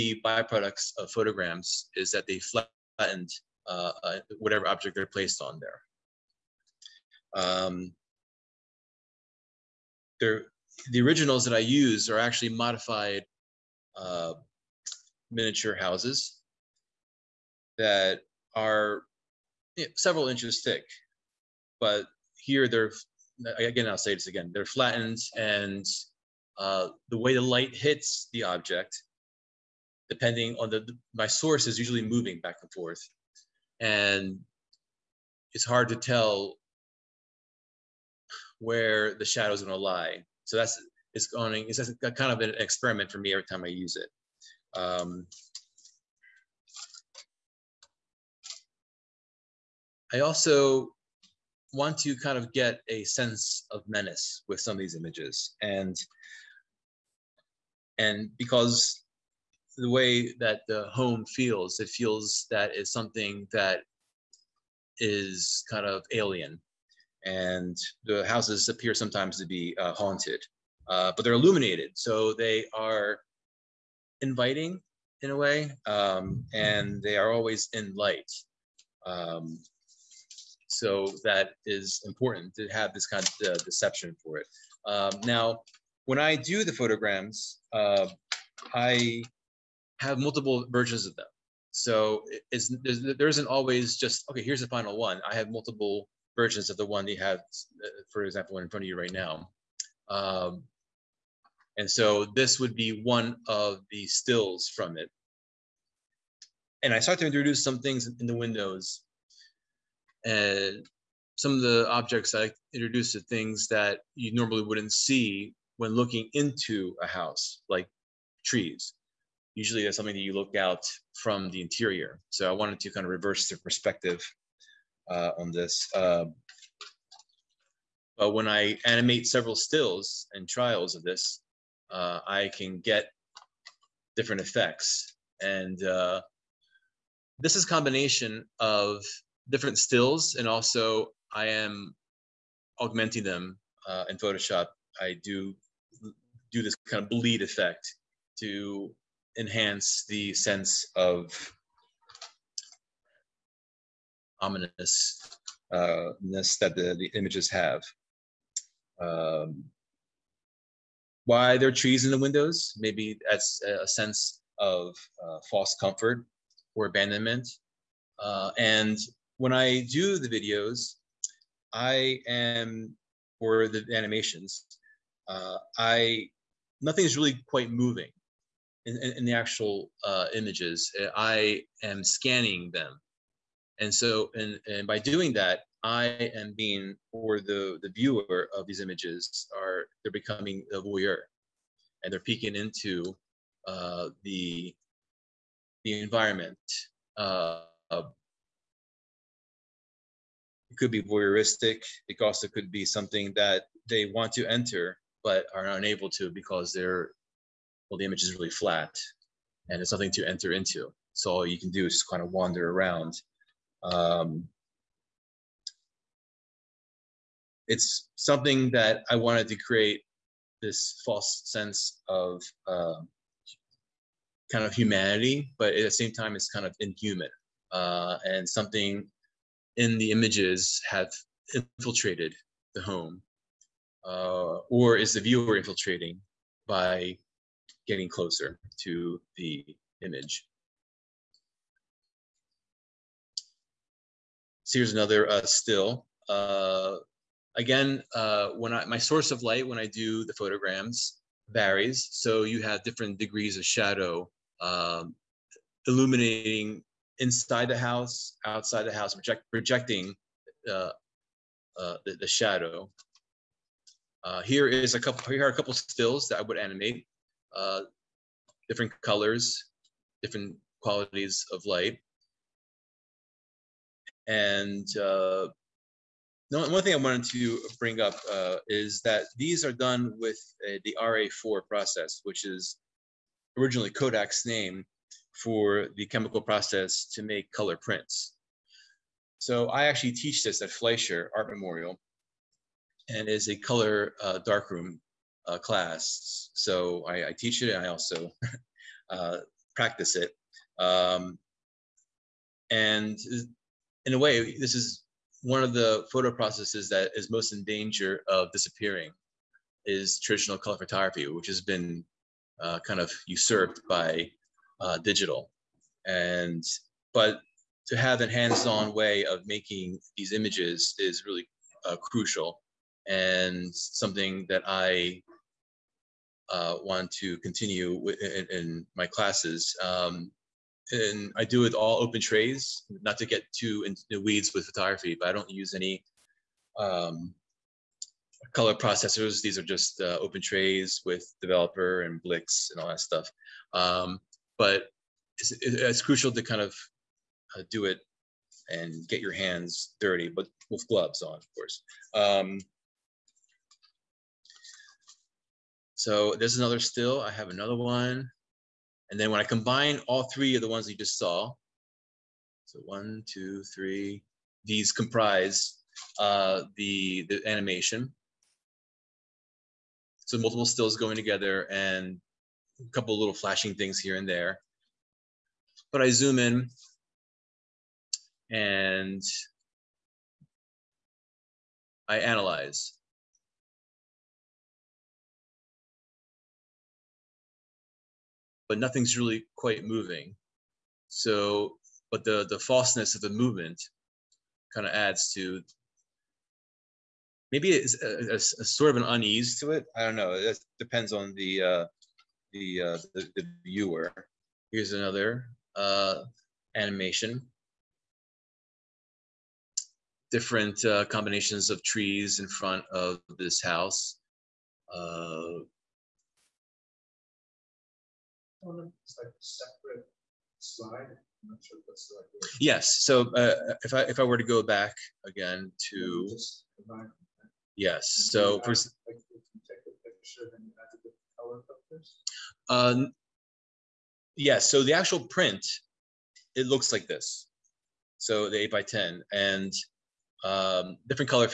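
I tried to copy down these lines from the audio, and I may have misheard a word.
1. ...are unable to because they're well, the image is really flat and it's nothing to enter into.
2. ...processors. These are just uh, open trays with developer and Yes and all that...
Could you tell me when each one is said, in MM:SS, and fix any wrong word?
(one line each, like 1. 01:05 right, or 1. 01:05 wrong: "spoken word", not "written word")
1. 03:25 right
2. 05:38 wrong: "Blix", not "Yes".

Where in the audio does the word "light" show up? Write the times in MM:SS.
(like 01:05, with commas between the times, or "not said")
00:27, 01:17, 04:09, 04:31.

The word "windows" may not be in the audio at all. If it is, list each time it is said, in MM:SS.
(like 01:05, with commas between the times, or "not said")
01:48, 02:42.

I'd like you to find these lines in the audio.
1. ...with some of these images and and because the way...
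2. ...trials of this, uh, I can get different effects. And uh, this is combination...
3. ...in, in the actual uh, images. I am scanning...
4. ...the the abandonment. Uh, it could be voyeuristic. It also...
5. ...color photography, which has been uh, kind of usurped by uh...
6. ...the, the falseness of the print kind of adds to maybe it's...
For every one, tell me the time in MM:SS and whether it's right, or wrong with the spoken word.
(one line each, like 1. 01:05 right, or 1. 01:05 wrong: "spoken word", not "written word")
1. 00:54 right
2. 02:10 right
3. 02:59 right
4. 03:14 wrong: "environment", not "abandonment"
5. 05:10 right
6. 06:32 wrong: "movement", not "print".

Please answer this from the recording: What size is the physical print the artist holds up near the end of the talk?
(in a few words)
8 by 10.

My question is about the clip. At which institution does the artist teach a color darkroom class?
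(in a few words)
Fleisher Art Memorial.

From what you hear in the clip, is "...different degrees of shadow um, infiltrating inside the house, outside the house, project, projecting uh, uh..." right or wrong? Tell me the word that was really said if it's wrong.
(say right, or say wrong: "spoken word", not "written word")
wrong: "illuminating", not "infiltrating".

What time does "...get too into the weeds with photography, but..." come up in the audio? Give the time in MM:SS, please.
05:33.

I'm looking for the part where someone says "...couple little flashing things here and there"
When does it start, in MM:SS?
06:12.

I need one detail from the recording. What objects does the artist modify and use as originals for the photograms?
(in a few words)
miniature houses.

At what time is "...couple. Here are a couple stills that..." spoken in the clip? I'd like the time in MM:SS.
04:25.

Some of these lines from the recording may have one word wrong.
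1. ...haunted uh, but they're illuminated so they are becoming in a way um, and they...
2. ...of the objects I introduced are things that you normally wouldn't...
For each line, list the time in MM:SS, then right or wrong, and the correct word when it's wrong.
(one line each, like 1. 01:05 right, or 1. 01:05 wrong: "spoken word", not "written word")
1. 01:09 wrong: "inviting", not "becoming"
2. 01:51 right.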